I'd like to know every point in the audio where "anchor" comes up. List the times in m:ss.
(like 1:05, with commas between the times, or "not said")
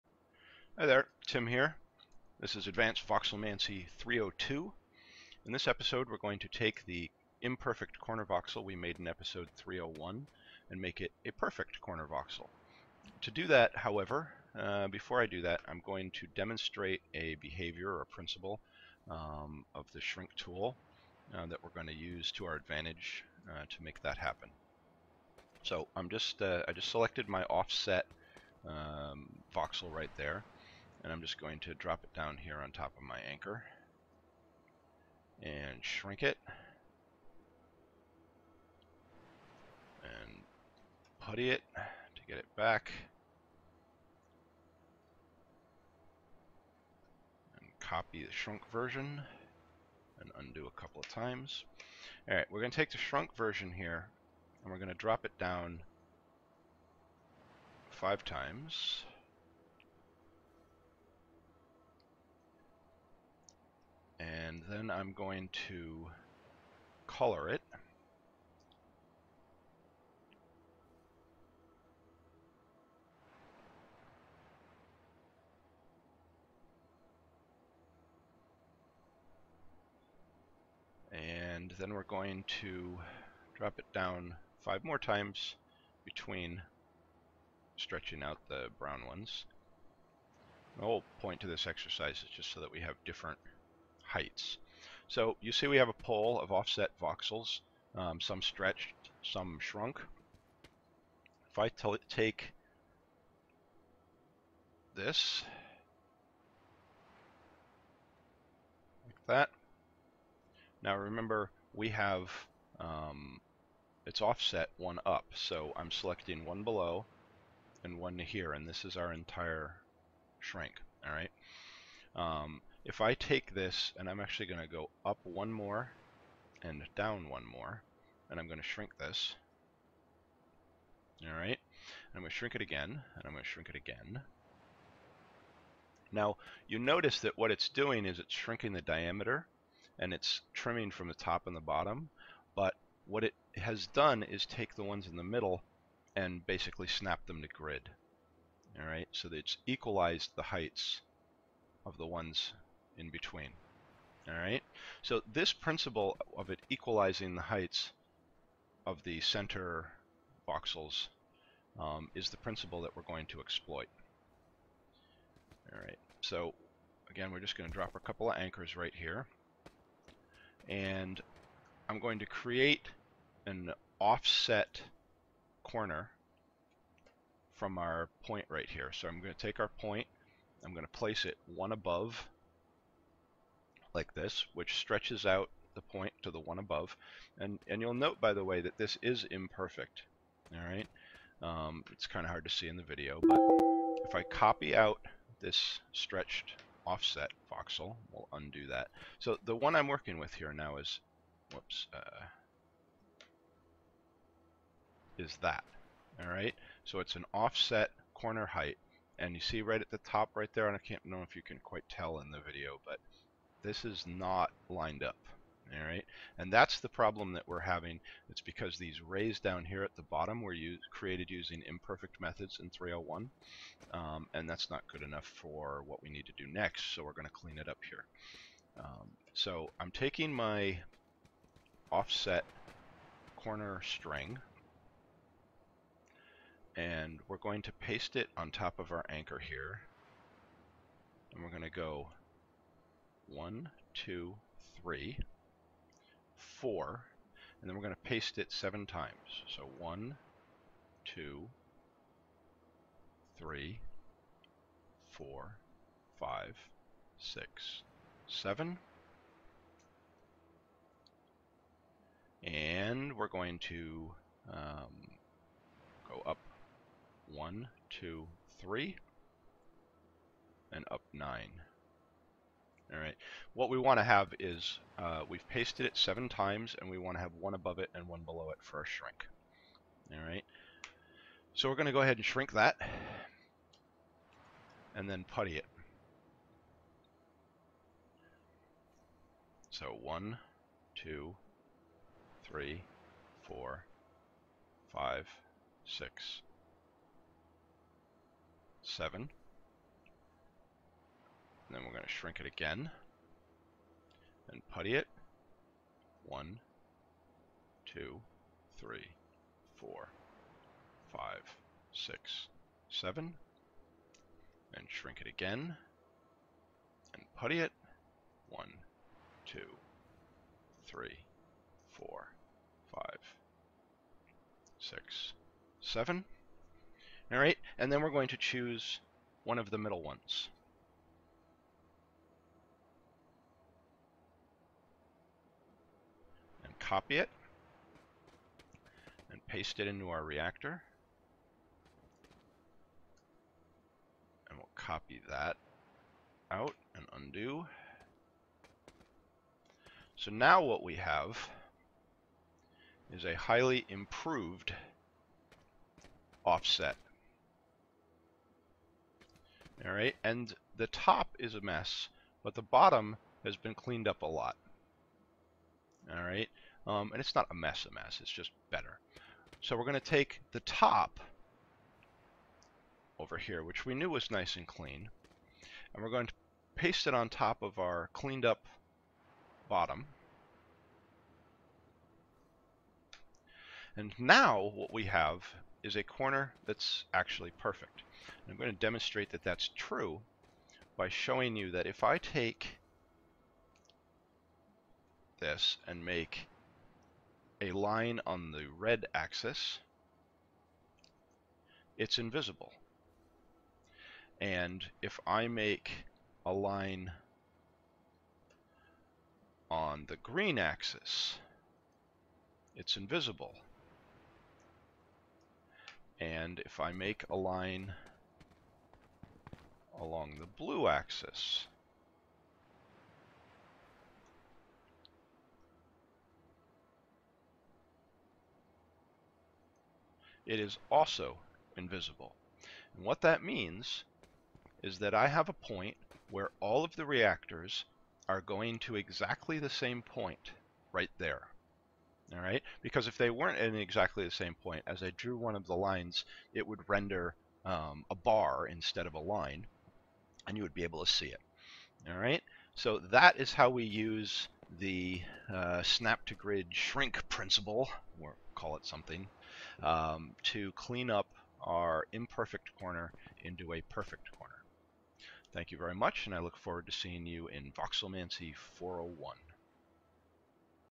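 0:33, 2:48, 3:59.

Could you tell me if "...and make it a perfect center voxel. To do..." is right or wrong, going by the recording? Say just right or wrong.
wrong.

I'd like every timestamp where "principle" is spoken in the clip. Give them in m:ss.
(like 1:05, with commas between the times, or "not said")
0:18, 2:35, 2:42, 7:37.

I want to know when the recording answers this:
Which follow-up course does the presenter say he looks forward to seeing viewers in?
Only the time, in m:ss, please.
7:47.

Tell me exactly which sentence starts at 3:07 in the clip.
And, and you'll note, by the way, that this is imperfect.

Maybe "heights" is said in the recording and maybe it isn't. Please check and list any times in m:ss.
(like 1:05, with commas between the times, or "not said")
1:34, 2:30, 2:37, 3:28.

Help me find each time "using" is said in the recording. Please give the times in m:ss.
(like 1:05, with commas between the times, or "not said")
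3:41.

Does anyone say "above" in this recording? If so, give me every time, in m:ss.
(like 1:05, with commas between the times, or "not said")
3:01, 3:06, 4:37.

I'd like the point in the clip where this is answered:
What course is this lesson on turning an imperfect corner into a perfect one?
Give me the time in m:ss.
0:02.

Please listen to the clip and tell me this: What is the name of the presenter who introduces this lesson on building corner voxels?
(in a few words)
Tim.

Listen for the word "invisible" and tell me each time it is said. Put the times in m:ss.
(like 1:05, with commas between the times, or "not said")
6:42, 6:52, 7:11.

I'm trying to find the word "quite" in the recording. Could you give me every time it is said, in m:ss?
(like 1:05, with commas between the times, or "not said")
3:31.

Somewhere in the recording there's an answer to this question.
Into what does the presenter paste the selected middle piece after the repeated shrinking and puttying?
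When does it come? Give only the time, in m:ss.
5:40.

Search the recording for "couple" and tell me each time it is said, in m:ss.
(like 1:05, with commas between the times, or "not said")
0:50, 2:47.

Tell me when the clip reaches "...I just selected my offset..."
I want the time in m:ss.
0:26.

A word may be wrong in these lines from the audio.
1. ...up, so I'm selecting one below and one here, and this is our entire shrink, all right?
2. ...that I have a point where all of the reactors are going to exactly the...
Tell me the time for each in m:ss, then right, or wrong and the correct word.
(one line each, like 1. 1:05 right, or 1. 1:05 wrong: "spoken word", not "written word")
1. 1:55 right
2. 7:14 right.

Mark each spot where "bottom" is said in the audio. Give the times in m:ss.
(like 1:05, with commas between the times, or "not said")
2:21, 3:40, 6:02, 6:19.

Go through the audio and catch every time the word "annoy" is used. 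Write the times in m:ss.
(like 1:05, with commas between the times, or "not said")
not said.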